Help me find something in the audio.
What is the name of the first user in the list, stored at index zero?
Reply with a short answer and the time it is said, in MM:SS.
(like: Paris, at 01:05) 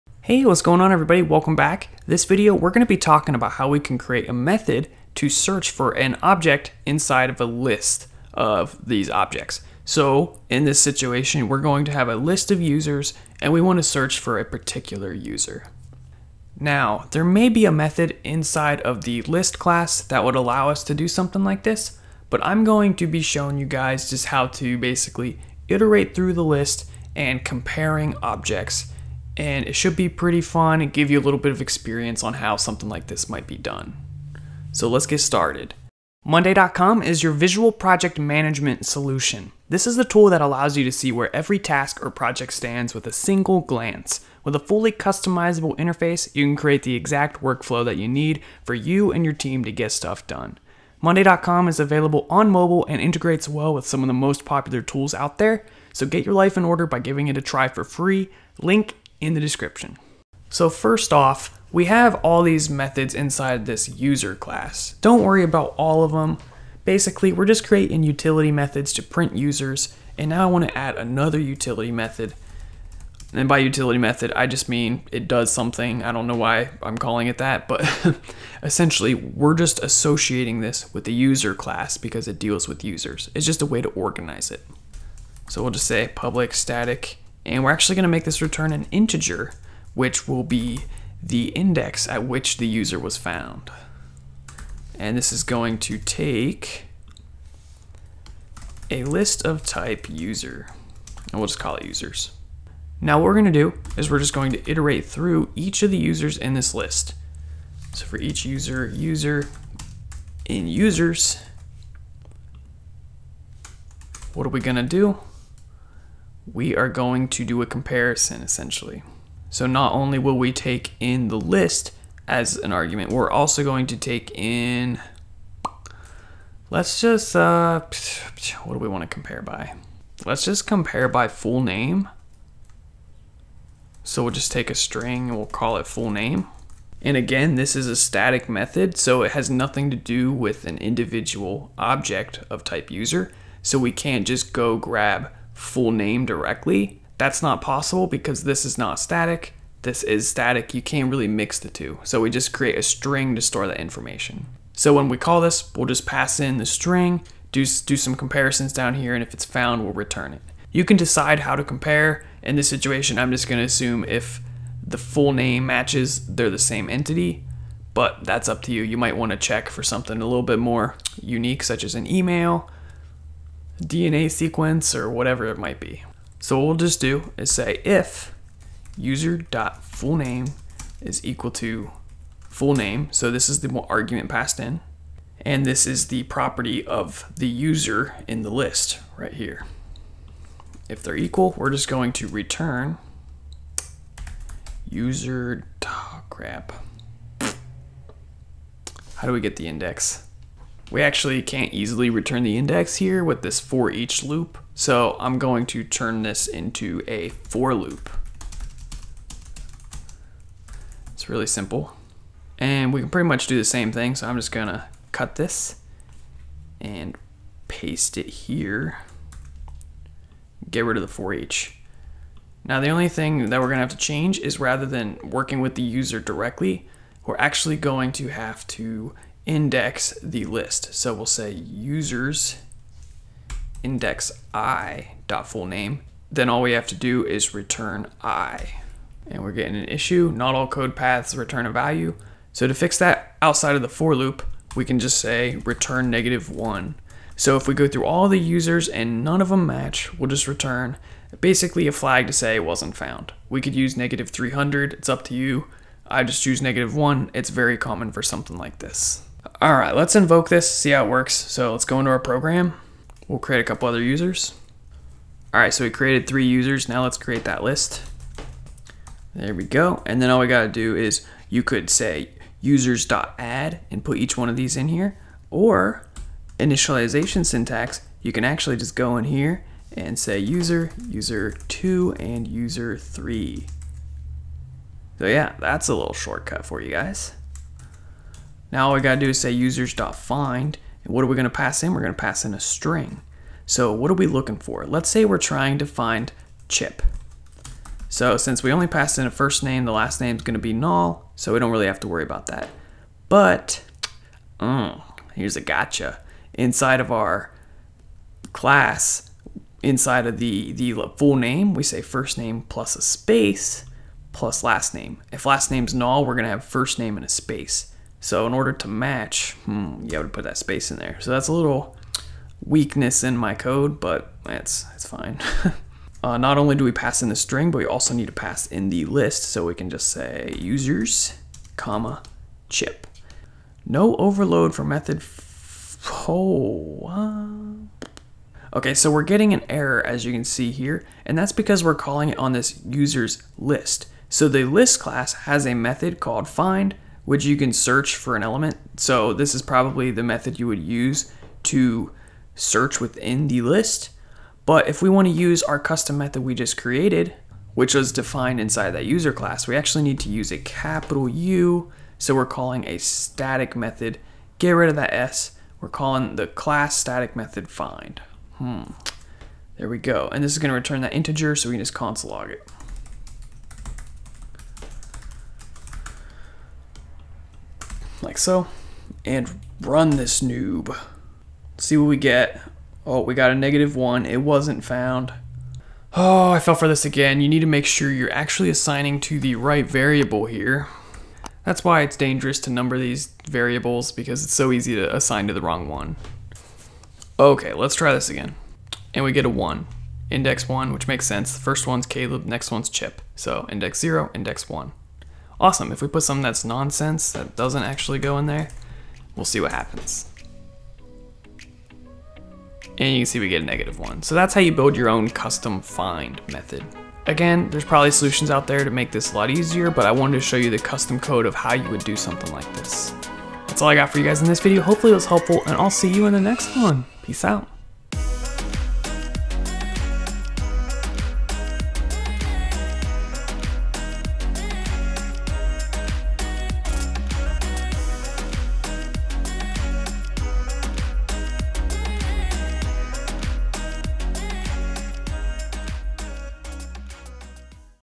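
Caleb, at 06:42.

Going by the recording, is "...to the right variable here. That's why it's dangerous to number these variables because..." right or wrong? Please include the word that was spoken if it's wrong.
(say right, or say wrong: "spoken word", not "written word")
right.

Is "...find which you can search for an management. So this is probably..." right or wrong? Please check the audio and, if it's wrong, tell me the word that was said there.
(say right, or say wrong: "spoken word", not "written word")
wrong: "element", not "management".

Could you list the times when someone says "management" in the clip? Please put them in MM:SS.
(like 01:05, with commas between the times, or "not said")
00:38.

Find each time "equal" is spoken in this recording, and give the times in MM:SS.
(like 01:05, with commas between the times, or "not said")
03:01, 03:11.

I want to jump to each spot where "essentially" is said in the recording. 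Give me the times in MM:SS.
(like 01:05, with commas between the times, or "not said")
01:18, 01:58.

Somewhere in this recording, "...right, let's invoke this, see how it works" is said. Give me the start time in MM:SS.
04:19.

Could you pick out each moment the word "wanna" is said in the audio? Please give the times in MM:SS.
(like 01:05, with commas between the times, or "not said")
00:13, 02:49.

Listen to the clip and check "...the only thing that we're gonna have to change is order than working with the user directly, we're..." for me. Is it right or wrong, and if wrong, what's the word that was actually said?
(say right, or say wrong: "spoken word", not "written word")
wrong: "rather", not "order".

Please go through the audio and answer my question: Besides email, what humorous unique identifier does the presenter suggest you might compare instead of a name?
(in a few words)
DNA sequence.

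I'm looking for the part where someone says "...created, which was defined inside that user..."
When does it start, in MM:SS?
05:56.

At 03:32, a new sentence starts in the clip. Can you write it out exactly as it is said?
And we can pretty much do the same thing, so I'm just gonna cut this and paste it here.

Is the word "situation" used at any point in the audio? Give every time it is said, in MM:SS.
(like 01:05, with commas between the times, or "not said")
00:10, 02:42.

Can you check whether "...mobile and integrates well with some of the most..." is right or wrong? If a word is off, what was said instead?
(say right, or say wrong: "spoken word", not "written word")
right.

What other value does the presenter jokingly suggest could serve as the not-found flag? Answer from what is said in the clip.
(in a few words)
-300.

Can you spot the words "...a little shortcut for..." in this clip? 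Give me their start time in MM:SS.
04:45.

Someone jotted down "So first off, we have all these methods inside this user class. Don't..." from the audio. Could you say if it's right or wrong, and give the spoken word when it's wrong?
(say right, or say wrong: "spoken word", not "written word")
right.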